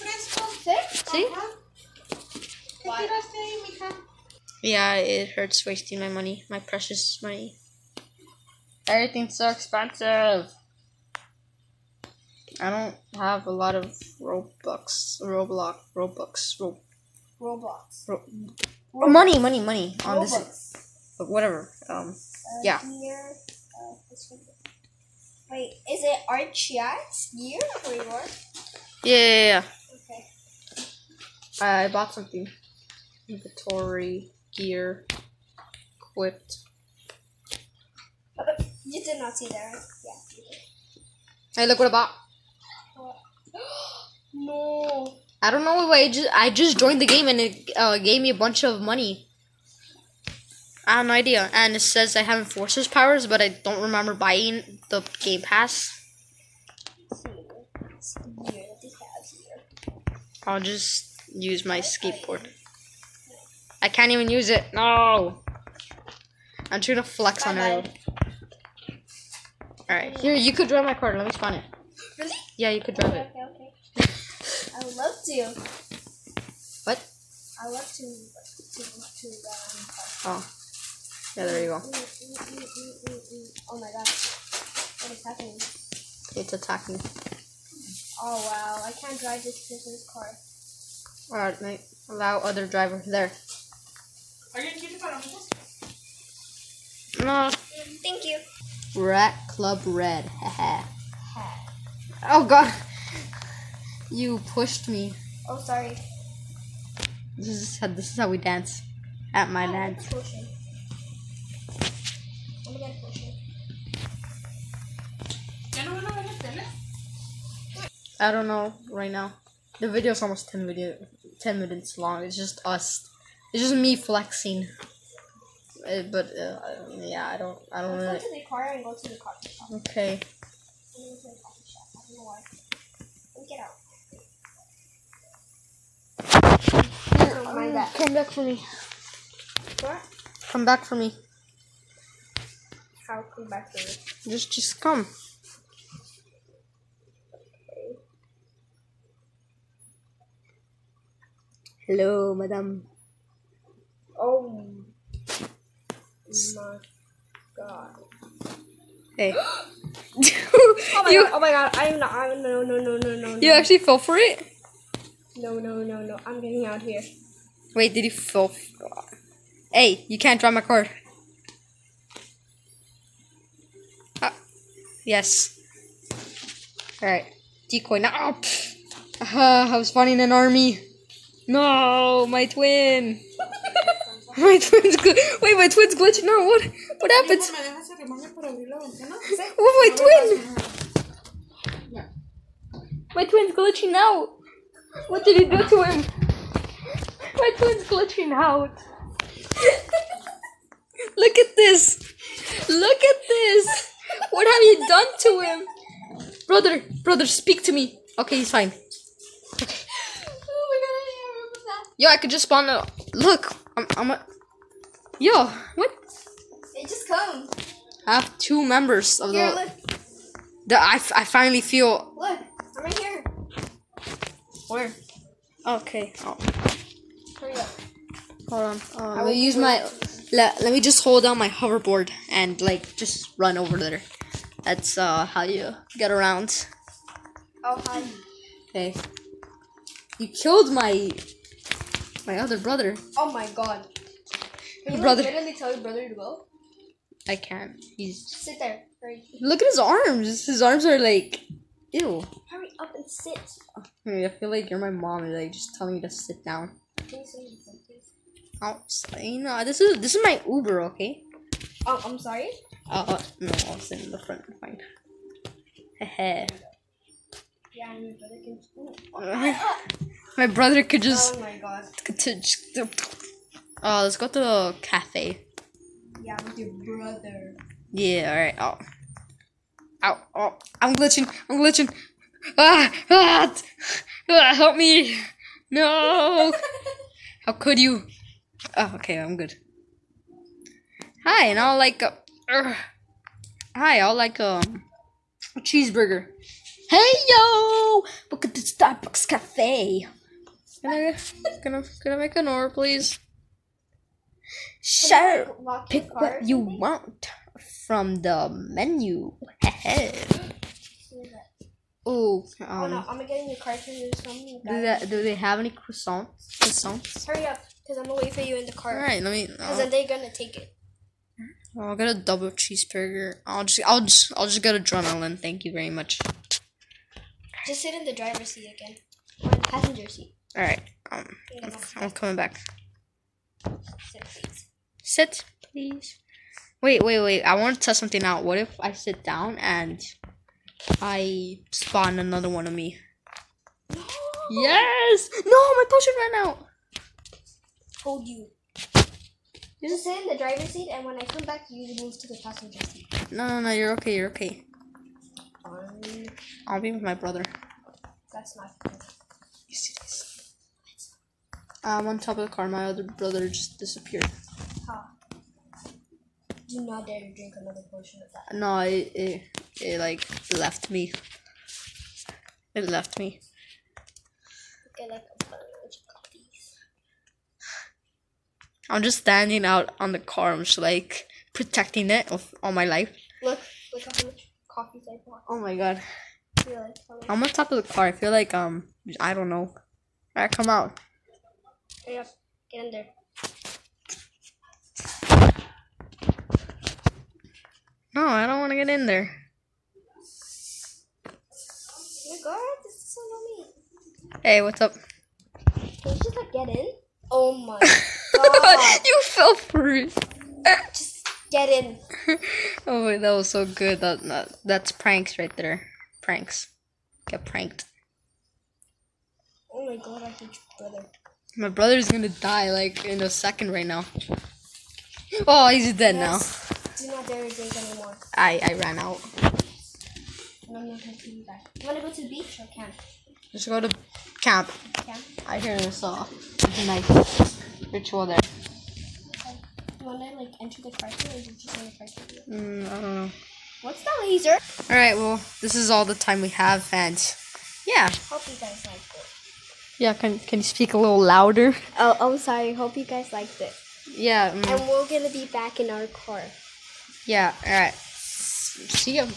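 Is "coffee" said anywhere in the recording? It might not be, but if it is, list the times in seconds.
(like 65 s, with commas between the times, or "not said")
129 s, 384 s.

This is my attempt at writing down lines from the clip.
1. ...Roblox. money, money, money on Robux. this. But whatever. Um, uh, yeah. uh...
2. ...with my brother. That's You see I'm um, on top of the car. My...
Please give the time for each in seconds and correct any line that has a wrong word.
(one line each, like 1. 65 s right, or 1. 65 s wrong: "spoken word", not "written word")
1. 18 s right
2. 356 s right.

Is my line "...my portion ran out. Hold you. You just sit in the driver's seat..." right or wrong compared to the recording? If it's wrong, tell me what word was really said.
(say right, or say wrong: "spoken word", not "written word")
wrong: "potion", not "portion".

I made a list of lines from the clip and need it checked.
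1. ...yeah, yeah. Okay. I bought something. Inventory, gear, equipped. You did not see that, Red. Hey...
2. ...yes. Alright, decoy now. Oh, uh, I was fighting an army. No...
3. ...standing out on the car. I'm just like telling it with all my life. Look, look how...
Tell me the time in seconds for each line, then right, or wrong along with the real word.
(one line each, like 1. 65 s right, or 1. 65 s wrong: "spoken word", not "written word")
1. 29 s wrong: "Yeah", not "Red"
2. 175 s right
3. 379 s wrong: "protecting", not "telling".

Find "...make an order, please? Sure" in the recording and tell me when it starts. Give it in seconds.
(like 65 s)
302 s.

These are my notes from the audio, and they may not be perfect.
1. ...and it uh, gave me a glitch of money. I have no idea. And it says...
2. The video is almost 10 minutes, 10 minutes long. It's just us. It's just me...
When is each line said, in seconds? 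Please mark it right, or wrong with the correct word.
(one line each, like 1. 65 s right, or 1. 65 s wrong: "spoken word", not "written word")
1. 47 s wrong: "bunch", not "glitch"
2. 119 s right.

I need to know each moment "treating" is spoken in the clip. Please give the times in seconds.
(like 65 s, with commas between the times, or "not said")
not said.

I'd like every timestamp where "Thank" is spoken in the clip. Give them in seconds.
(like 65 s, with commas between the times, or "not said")
97 s, 325 s.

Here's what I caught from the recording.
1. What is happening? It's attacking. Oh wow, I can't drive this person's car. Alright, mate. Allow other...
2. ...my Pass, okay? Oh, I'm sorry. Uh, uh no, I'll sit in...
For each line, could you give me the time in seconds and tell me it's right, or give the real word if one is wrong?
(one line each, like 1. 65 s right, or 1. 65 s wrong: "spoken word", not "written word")
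1. 84 s right
2. 260 s wrong: "Uber", not "Pass".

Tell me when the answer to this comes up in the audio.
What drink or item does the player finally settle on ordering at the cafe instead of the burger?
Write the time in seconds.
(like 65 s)
324 s.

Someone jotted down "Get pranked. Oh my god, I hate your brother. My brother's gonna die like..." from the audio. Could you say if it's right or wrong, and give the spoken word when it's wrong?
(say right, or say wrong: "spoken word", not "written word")
right.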